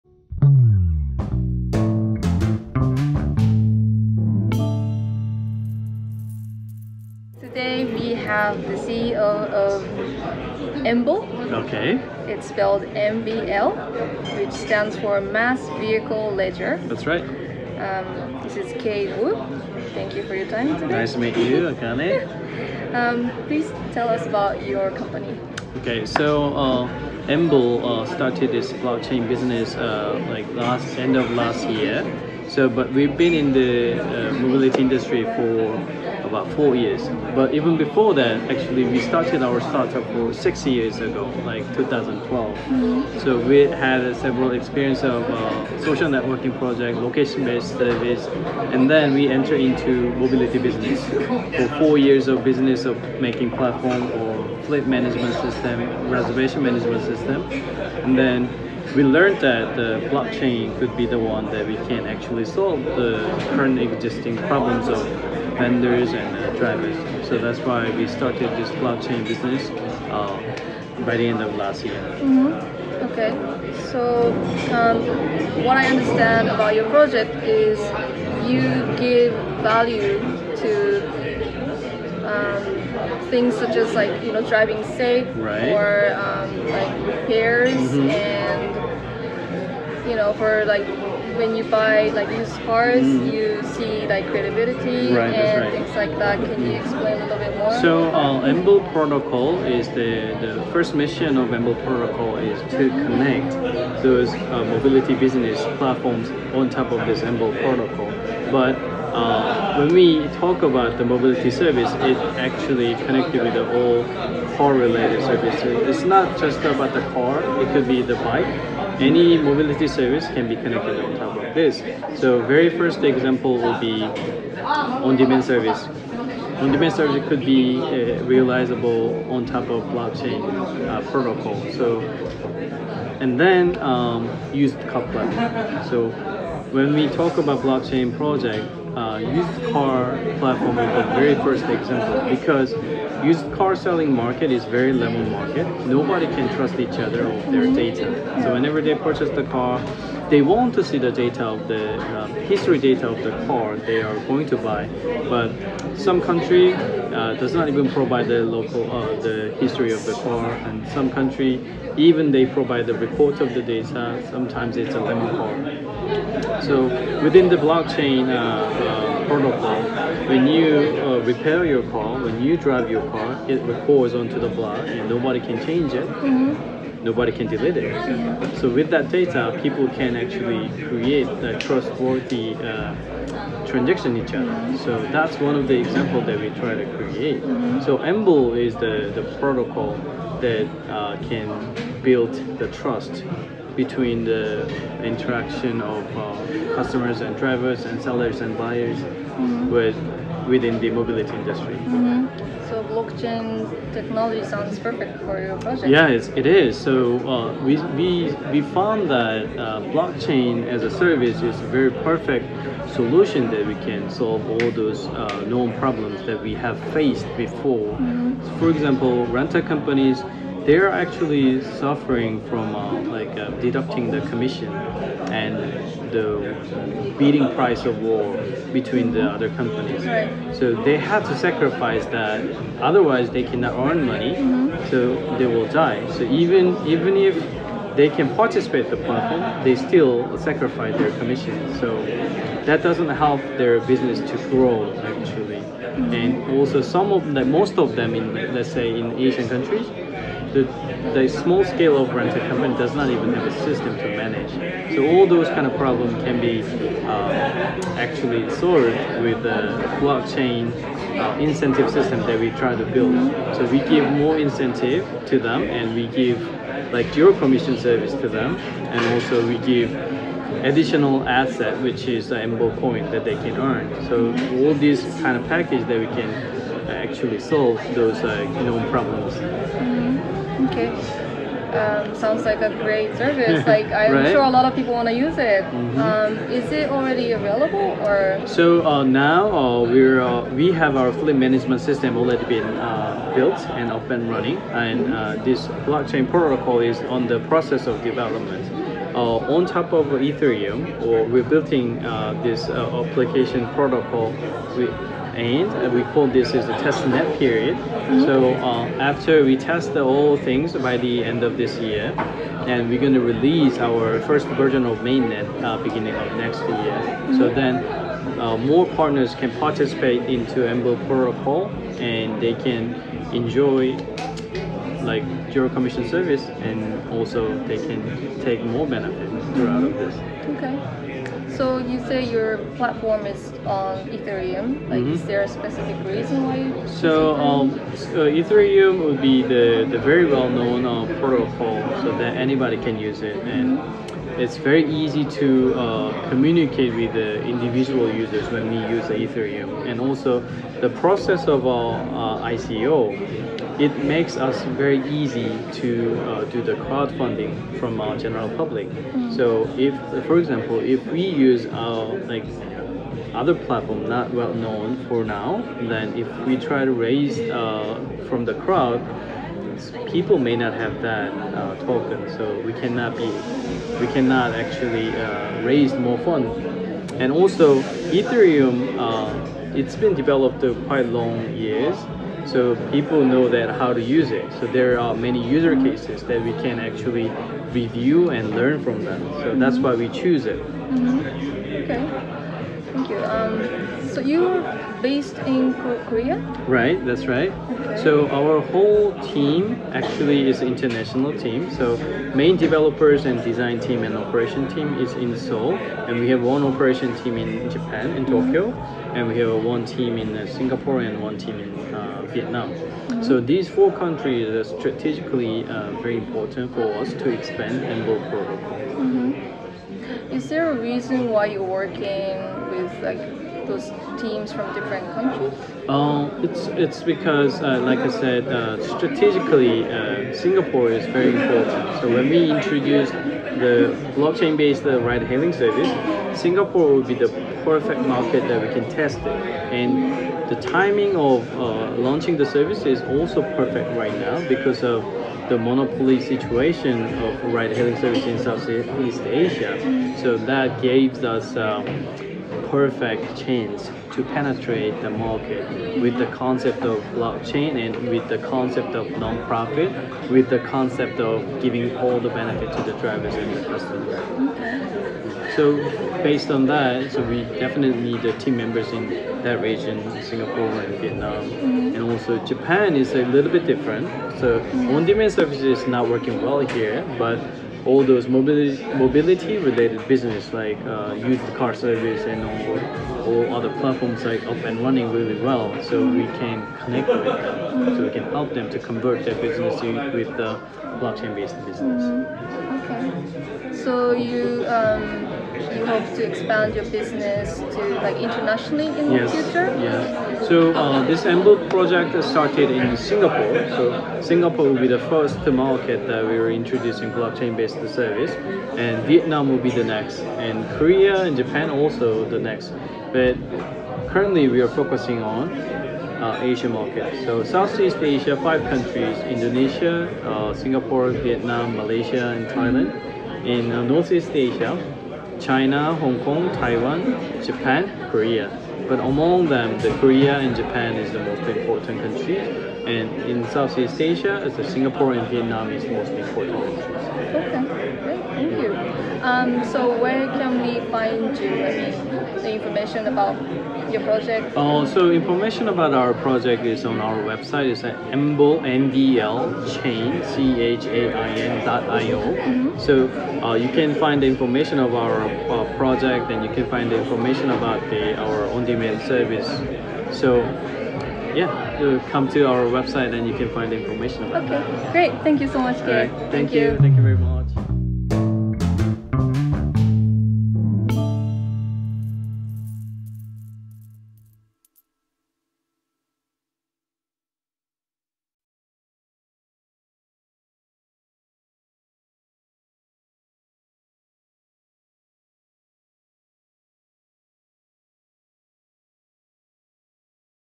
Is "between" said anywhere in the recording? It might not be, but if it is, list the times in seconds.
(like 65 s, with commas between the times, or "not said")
193 s, 228 s.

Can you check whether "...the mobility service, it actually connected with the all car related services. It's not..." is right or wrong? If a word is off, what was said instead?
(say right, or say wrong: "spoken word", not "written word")
right.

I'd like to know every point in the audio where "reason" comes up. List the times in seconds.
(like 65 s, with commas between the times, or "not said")
336 s, 420 s.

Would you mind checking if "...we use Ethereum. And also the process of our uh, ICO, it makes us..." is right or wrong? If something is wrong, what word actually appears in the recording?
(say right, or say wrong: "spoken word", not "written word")
right.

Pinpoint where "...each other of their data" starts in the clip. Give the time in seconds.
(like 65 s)
146 s.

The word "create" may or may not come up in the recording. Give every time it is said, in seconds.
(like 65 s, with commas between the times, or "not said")
180 s, 186 s.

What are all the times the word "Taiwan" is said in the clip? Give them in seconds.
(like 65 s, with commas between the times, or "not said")
526 s.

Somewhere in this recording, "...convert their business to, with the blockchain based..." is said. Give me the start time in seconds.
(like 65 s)
488 s.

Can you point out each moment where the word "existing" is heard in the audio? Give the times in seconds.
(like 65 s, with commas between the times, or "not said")
63 s.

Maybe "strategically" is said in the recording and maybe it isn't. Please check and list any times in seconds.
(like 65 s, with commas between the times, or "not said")
414 s, 428 s.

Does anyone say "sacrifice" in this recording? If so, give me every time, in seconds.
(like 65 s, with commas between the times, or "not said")
231 s, 240 s.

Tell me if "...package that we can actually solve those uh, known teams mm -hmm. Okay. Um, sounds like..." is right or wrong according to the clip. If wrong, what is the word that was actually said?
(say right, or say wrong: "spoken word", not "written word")
wrong: "problems", not "teams".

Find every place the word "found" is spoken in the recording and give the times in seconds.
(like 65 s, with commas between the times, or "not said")
208 s.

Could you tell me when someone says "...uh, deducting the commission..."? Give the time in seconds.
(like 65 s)
223 s.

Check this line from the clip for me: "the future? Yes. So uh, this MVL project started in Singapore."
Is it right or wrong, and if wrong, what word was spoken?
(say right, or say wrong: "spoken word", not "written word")
right.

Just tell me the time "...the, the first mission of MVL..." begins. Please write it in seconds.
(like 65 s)
99 s.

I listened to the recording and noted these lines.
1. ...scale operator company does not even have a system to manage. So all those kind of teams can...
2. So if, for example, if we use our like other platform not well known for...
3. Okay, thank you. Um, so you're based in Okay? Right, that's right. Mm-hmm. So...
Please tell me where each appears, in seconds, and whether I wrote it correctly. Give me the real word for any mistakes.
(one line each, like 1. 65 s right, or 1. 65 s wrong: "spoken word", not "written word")
1. 251 s wrong: "problems", not "teams"
2. 359 s right
3. 391 s wrong: "Korea", not "Okay".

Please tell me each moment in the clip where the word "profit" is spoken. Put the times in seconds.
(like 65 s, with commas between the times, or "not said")
459 s.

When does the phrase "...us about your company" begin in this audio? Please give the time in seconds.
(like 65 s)
24 s.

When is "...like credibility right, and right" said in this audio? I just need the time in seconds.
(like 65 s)
94 s.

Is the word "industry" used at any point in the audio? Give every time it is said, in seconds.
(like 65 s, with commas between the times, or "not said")
34 s, 201 s.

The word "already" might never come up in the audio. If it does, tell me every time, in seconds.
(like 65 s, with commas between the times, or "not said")
286 s, 292 s.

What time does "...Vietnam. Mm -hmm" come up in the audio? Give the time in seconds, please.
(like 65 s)
471 s.